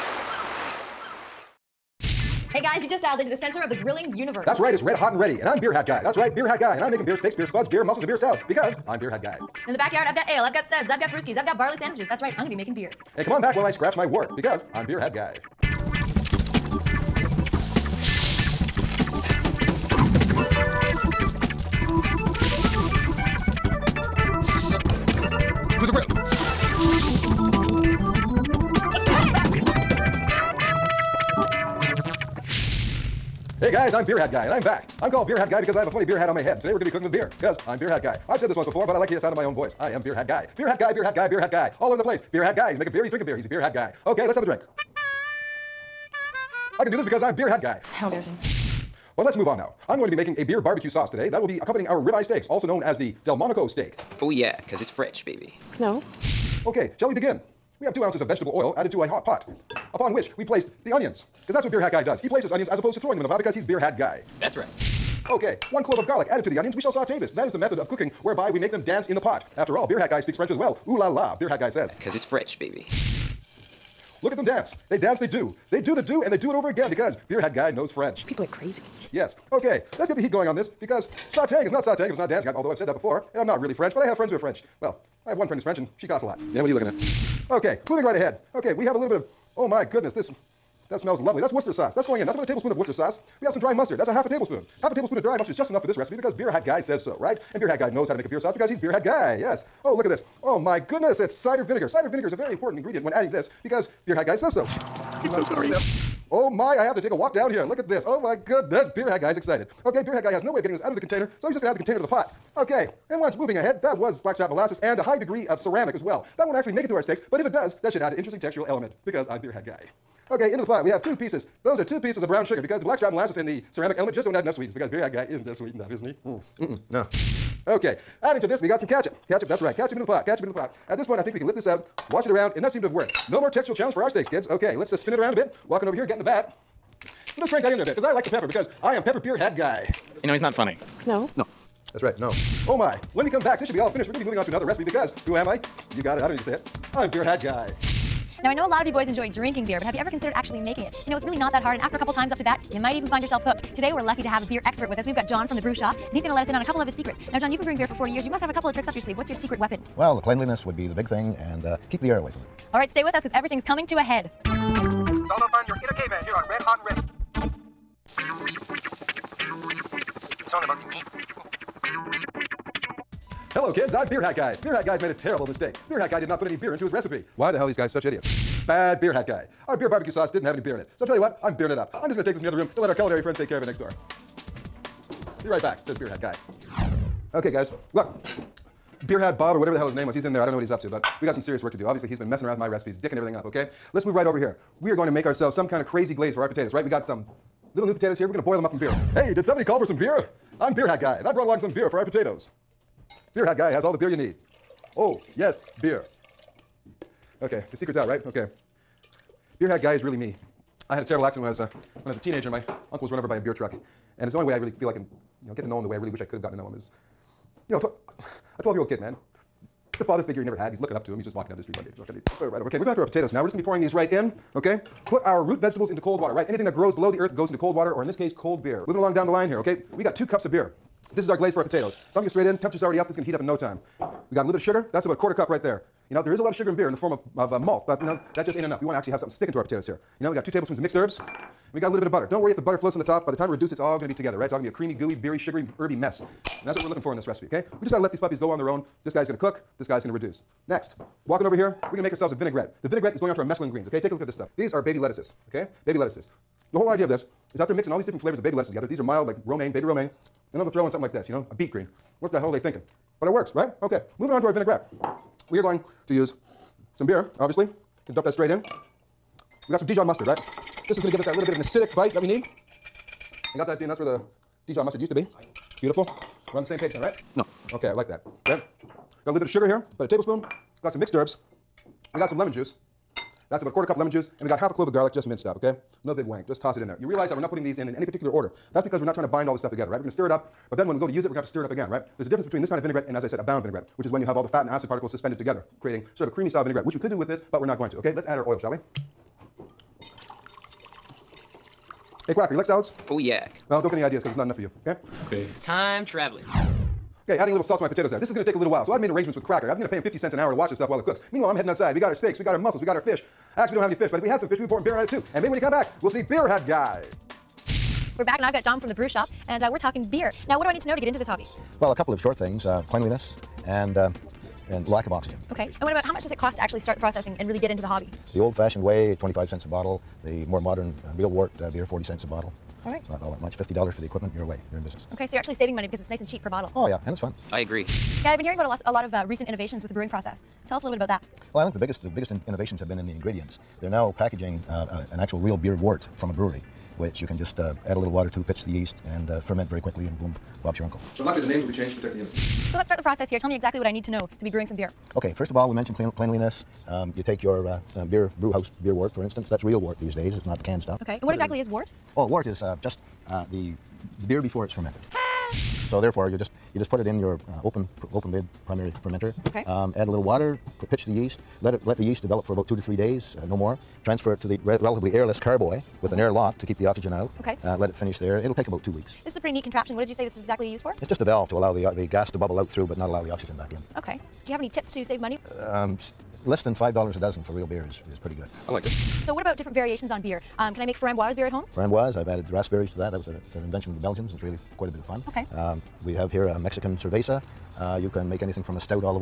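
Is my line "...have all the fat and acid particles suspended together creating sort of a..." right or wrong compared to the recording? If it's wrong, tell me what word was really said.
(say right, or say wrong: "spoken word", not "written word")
right.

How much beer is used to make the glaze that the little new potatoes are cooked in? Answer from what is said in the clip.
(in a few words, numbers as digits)
2 cups.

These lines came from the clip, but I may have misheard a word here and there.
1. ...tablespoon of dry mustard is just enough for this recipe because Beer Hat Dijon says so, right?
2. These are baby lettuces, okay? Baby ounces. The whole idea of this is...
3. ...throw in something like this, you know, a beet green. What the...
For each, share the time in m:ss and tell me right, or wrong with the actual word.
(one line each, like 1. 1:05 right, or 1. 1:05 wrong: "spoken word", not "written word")
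1. 1:34 wrong: "Guy", not "Dijon"
2. 4:14 wrong: "lettuces", not "ounces"
3. 4:20 right.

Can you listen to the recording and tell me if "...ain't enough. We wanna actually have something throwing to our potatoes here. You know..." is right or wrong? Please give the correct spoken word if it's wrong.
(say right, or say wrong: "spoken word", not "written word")
wrong: "sticking", not "throwing".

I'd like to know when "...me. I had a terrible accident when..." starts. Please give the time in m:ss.
3:30.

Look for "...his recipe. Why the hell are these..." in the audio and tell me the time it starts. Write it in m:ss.
2:56.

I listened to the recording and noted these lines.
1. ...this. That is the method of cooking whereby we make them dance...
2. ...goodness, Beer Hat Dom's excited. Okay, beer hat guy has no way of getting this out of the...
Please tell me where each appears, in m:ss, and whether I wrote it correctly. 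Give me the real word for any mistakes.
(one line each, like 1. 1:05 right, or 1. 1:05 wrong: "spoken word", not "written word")
1. 1:07 right
2. 1:48 wrong: "Guy", not "Dom".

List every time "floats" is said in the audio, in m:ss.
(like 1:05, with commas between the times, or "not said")
4:02.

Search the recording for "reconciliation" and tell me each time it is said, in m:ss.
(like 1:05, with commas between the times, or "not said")
not said.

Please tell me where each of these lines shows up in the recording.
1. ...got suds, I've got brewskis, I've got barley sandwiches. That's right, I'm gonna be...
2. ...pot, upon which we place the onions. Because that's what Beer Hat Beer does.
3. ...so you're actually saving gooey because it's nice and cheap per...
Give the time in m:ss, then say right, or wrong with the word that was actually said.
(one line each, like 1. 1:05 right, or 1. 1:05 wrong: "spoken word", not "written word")
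1. 0:10 right
2. 0:59 wrong: "Guy", not "Beer"
3. 5:35 wrong: "money", not "gooey".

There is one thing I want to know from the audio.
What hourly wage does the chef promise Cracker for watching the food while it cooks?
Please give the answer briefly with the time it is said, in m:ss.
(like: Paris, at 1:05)
50 cents, at 5:10.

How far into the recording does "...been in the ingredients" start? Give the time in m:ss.
5:42.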